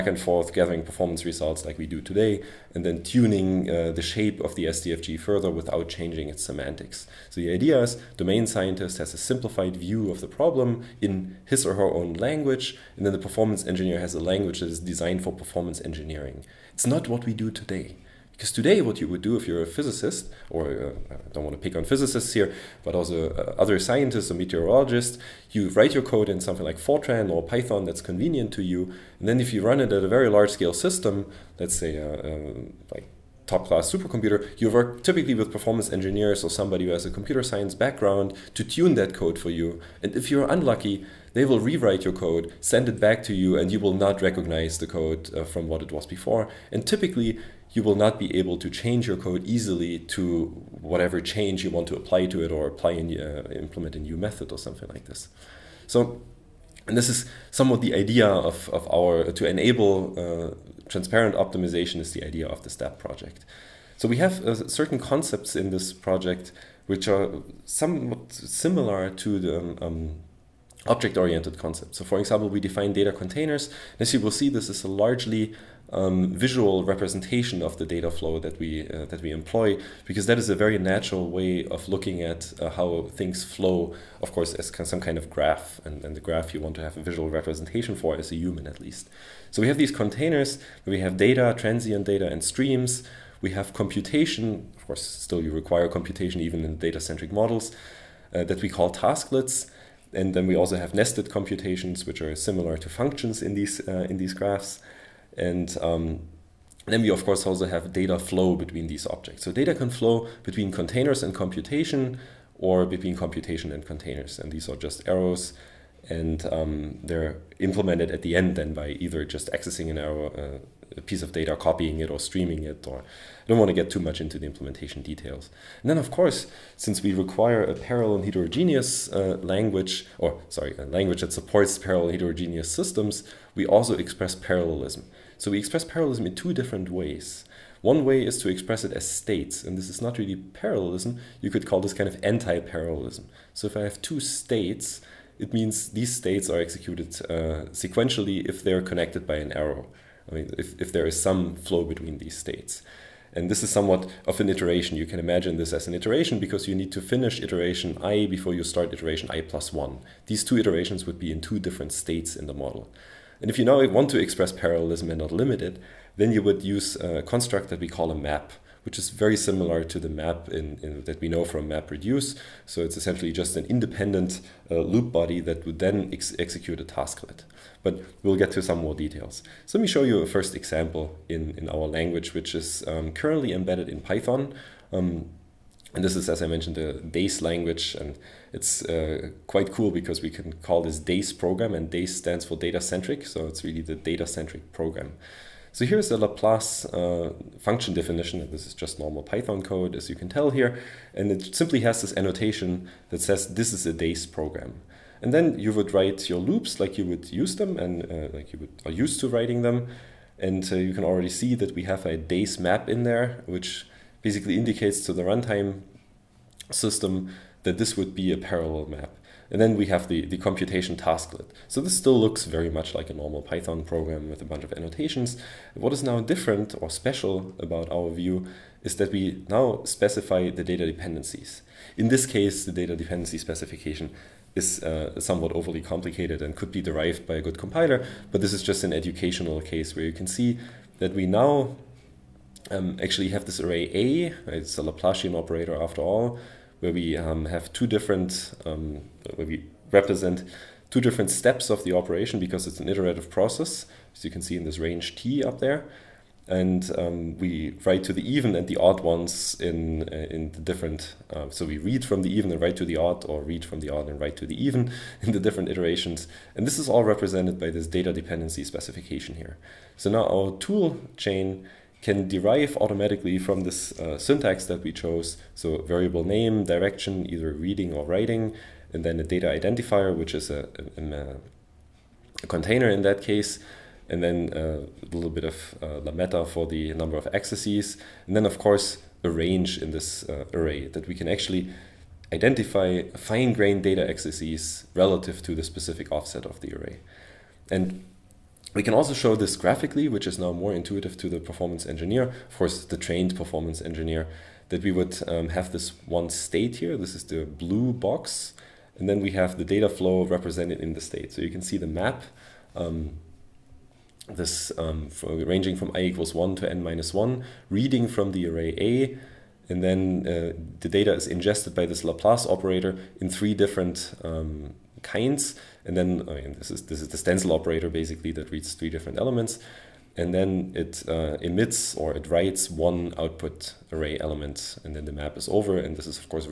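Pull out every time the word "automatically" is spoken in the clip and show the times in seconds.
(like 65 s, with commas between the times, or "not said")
272 s.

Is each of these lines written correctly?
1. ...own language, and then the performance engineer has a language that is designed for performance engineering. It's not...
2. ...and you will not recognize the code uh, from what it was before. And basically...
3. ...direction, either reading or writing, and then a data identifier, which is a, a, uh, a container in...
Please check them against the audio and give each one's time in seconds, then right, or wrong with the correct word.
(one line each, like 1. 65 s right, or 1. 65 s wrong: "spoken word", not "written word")
1. 11 s right
2. 43 s wrong: "typically", not "basically"
3. 276 s right.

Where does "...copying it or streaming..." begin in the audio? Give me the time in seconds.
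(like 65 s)
121 s.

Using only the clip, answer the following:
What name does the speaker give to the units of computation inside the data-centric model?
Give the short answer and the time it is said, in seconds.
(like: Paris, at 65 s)
tasklets, at 98 s.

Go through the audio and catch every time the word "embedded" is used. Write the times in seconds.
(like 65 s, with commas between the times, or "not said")
183 s.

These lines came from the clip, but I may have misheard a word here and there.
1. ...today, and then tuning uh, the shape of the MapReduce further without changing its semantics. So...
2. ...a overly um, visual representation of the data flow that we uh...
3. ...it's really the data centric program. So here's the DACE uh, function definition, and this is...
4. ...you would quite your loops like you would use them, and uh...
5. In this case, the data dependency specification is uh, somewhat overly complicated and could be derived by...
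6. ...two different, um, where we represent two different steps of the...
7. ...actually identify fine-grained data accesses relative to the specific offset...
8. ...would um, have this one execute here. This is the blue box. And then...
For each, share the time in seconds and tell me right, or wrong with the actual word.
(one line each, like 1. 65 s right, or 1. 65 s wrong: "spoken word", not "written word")
1. 1 s wrong: "SDFG", not "MapReduce"
2. 74 s wrong: "largely", not "overly"
3. 193 s wrong: "Laplace", not "DACE"
4. 205 s wrong: "write", not "quite"
5. 231 s right
6. 247 s right
7. 291 s right
8. 304 s wrong: "state", not "execute".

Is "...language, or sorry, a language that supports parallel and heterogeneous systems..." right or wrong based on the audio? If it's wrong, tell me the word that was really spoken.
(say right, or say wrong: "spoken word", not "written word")
right.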